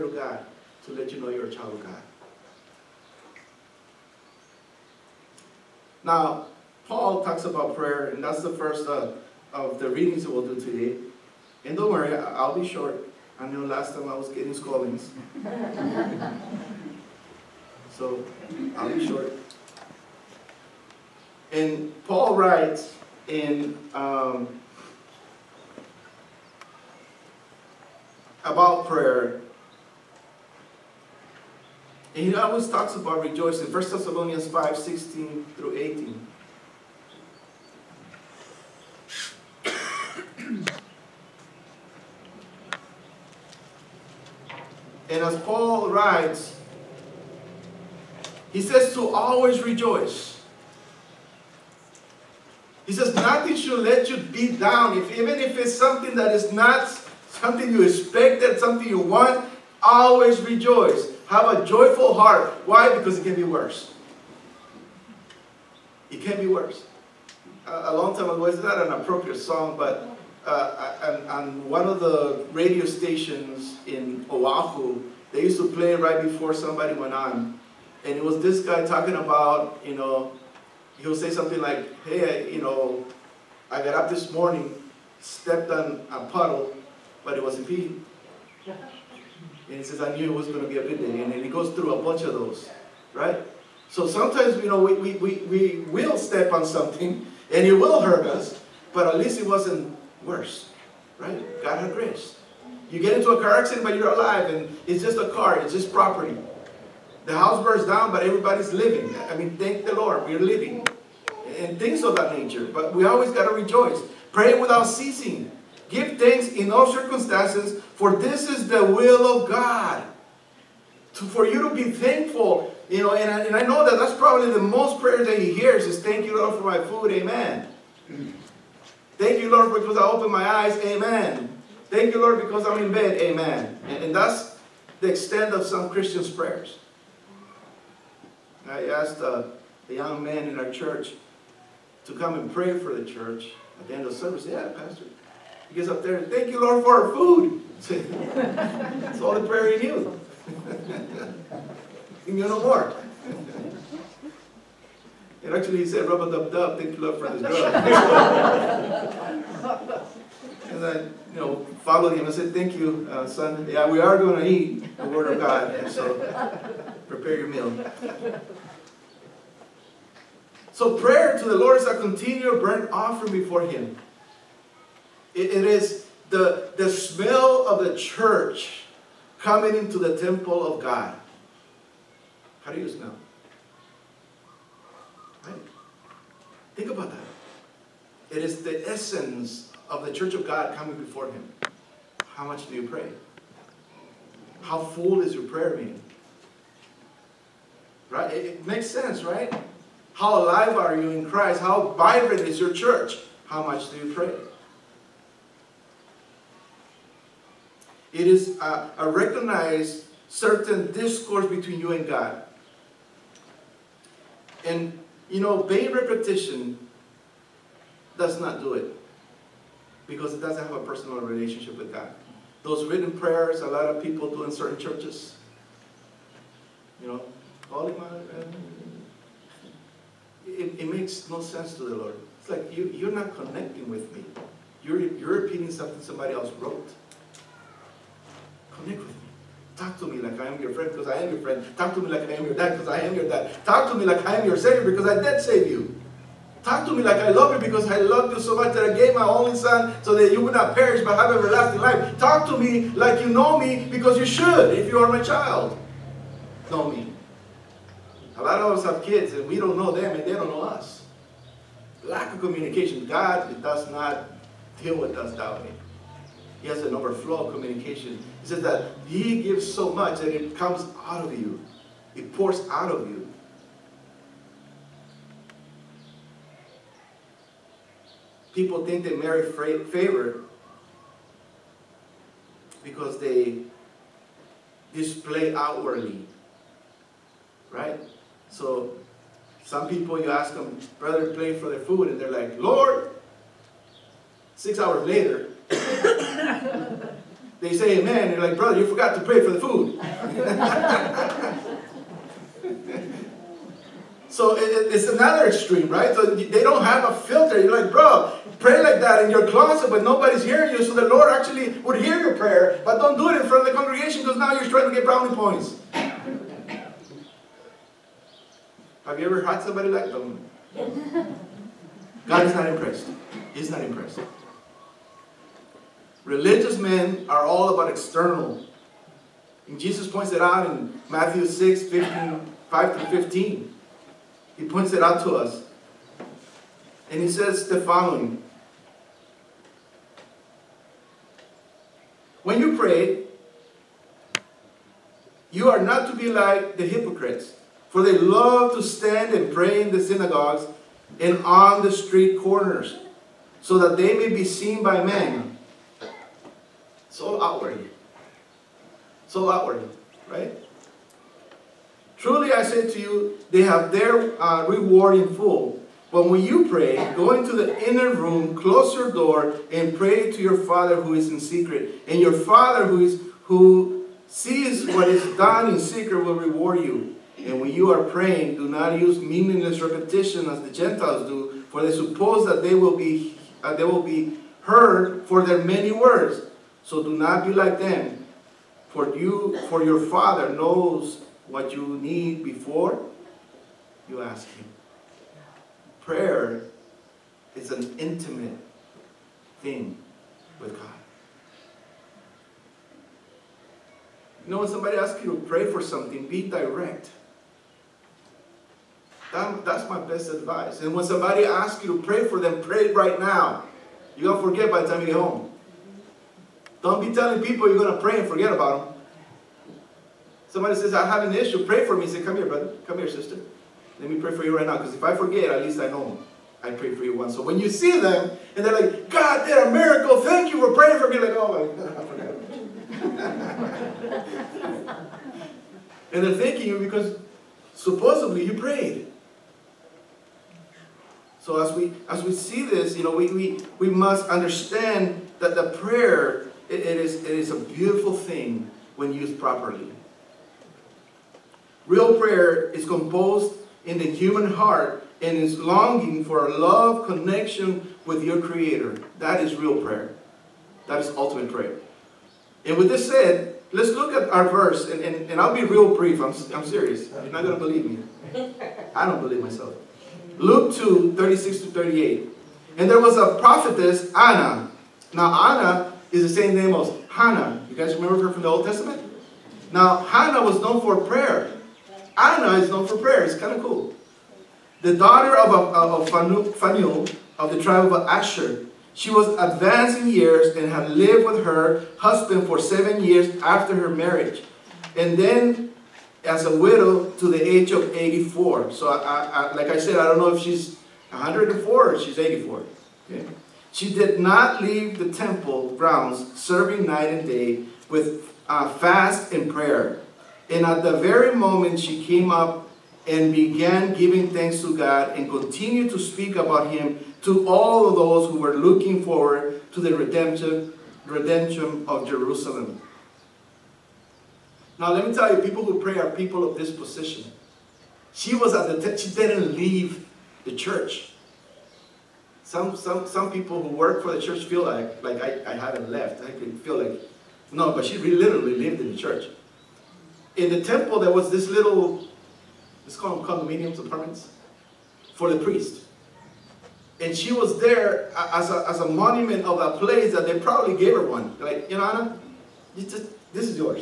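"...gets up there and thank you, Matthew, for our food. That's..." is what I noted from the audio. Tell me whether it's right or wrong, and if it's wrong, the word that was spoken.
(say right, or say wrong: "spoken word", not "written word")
wrong: "Lord", not "Matthew".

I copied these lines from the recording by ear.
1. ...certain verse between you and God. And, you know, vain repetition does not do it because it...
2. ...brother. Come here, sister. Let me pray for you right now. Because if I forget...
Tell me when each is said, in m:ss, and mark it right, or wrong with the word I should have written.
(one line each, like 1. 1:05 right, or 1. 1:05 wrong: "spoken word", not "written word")
1. 3:30 wrong: "discourse", not "verse"
2. 7:02 right.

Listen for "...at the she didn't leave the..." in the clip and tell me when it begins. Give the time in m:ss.
8:48.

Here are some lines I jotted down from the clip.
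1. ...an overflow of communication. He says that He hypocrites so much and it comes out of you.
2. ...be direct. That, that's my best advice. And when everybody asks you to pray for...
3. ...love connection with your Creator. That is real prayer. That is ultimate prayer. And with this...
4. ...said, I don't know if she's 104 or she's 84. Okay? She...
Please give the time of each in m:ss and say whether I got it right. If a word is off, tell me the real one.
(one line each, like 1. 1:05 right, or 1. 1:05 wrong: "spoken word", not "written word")
1. 4:26 wrong: "gives", not "hypocrites"
2. 6:46 wrong: "somebody", not "everybody"
3. 7:36 right
4. 8:19 right.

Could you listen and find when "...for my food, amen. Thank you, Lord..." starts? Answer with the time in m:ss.
2:06.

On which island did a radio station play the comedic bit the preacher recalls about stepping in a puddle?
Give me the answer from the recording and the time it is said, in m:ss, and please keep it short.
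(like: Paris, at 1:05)
Oahu, at 1:14.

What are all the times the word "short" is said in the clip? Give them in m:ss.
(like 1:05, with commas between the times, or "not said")
0:12, 0:19.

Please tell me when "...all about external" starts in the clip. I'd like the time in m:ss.
5:27.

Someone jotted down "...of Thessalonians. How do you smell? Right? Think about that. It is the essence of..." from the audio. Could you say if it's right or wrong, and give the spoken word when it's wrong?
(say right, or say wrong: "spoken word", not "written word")
wrong: "God", not "Thessalonians".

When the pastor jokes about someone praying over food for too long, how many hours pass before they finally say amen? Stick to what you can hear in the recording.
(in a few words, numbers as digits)
6.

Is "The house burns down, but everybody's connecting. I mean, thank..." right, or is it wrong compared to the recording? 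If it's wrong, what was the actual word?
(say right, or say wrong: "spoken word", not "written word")
wrong: "living", not "connecting".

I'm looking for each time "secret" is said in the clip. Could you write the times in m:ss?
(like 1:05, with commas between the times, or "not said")
6:11, 6:15.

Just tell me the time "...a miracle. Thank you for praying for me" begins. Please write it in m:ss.
7:09.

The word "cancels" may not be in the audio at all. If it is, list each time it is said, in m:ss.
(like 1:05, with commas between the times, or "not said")
not said.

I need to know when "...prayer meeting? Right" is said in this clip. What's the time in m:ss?
3:15.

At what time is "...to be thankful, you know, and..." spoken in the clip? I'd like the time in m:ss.
2:01.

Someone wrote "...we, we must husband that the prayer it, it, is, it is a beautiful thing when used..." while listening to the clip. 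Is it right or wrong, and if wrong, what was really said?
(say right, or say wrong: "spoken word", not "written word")
wrong: "understand", not "husband".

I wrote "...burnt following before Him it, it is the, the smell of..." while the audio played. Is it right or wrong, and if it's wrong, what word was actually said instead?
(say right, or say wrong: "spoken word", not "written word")
wrong: "offering", not "following".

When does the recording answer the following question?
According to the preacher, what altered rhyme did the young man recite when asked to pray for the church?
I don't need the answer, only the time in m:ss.
2:36.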